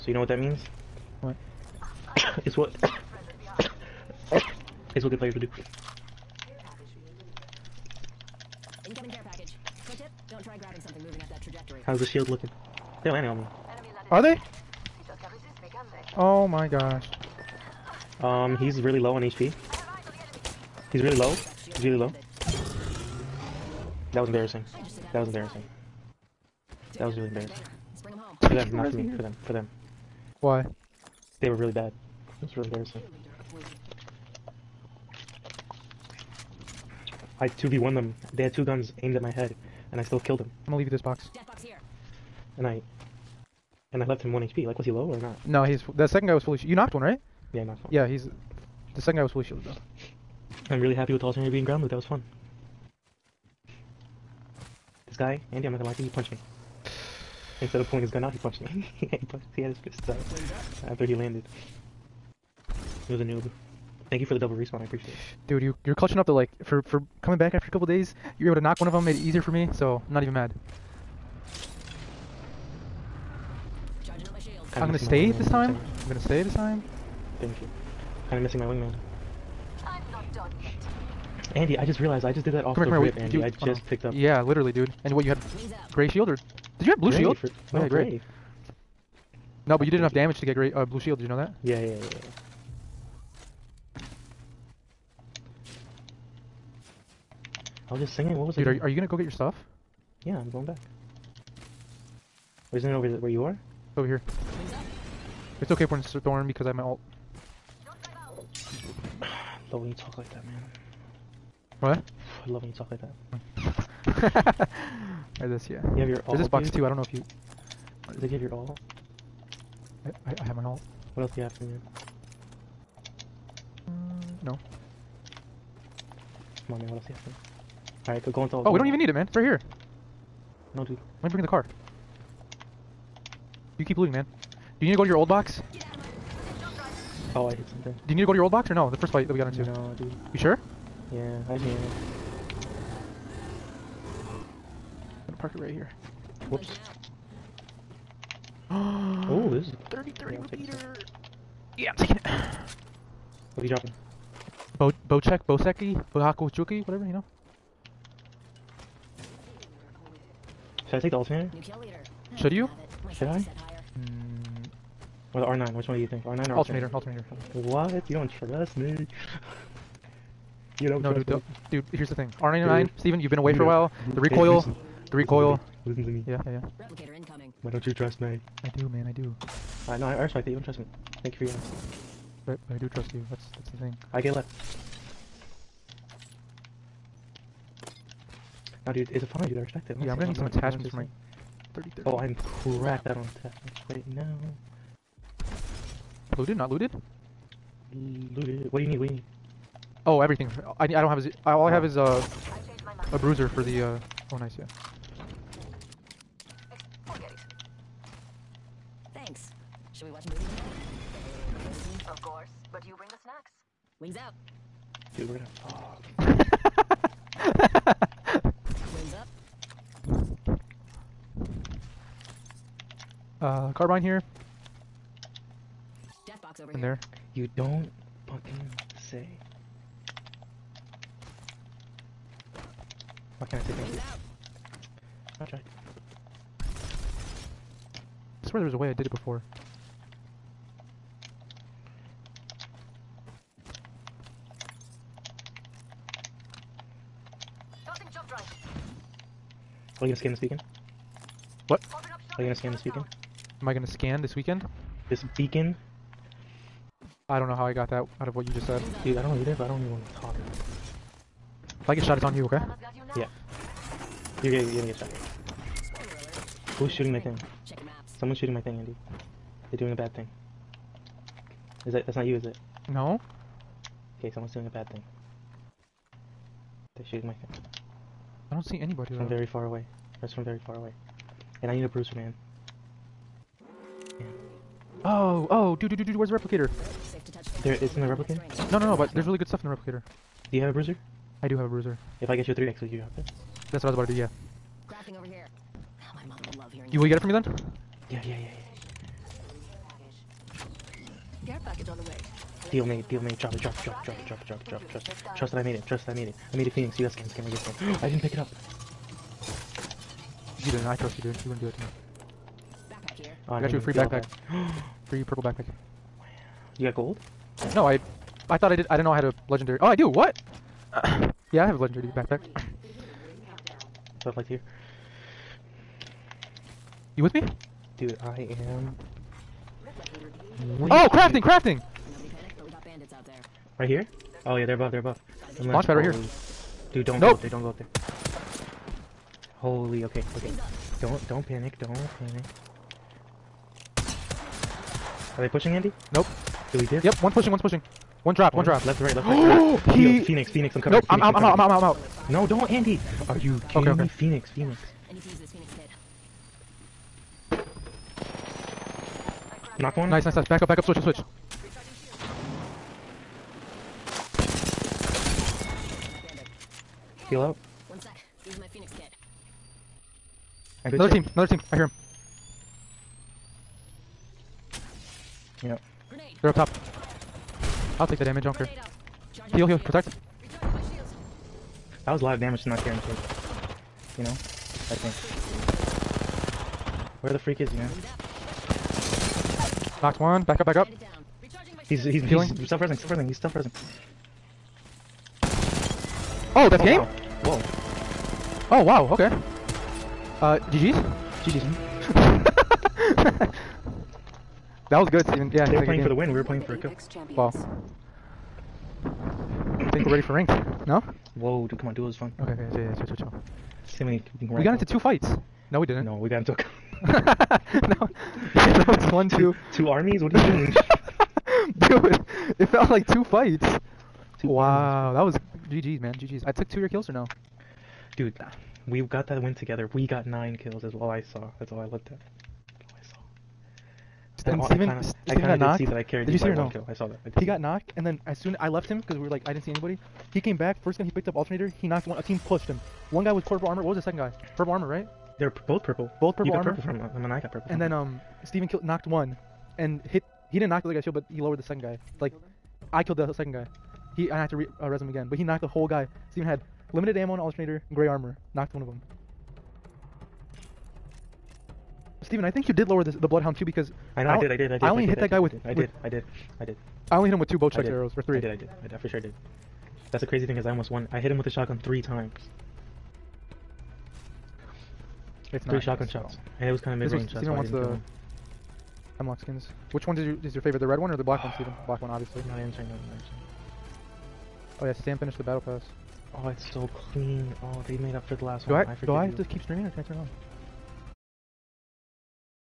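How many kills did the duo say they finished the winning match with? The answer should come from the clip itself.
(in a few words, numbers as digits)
9.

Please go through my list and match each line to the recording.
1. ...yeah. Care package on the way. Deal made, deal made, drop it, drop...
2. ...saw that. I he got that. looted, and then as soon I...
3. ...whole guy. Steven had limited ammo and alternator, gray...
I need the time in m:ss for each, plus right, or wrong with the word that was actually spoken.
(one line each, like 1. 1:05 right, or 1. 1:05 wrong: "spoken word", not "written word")
1. 4:58 right
2. 7:16 wrong: "knocked", not "looted"
3. 7:35 right.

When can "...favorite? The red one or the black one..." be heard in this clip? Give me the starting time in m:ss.
8:00.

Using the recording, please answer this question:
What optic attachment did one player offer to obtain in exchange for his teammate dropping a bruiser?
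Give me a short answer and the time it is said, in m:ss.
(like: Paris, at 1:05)
3x, at 4:52.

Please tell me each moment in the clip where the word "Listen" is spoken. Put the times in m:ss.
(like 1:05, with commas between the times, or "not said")
2:55.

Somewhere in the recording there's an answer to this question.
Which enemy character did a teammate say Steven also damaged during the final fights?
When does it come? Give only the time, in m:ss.
7:43.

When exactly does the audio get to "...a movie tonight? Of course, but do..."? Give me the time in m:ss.
3:30.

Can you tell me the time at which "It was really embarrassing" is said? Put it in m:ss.
0:32.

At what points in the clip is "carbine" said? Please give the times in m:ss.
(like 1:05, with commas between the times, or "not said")
3:43.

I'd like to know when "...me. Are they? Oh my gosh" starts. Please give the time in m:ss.
0:13.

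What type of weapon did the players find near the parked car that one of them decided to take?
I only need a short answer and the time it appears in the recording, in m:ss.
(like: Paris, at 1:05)
30-30 Repeater, at 2:29.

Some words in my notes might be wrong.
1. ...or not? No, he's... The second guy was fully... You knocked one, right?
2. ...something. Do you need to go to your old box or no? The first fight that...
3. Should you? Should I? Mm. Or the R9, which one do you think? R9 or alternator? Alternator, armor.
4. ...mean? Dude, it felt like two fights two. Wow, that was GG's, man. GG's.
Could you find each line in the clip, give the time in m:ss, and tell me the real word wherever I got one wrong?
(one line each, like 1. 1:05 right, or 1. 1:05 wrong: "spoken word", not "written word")
1. 0:45 right
2. 2:17 right
3. 2:42 wrong: "alternator", not "armor"
4. 7:00 right.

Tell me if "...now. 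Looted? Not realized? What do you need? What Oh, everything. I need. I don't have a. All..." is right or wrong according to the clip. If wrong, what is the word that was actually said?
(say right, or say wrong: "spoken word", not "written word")
wrong: "looted", not "realized".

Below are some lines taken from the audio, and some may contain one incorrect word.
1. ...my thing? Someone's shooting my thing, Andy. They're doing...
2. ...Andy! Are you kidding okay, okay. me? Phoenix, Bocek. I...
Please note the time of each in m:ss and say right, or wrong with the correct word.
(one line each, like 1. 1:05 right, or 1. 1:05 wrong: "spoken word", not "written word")
1. 4:27 right
2. 5:52 wrong: "Phoenix", not "Bocek".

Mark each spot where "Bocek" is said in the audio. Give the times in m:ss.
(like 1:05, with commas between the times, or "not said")
2:35, 7:47.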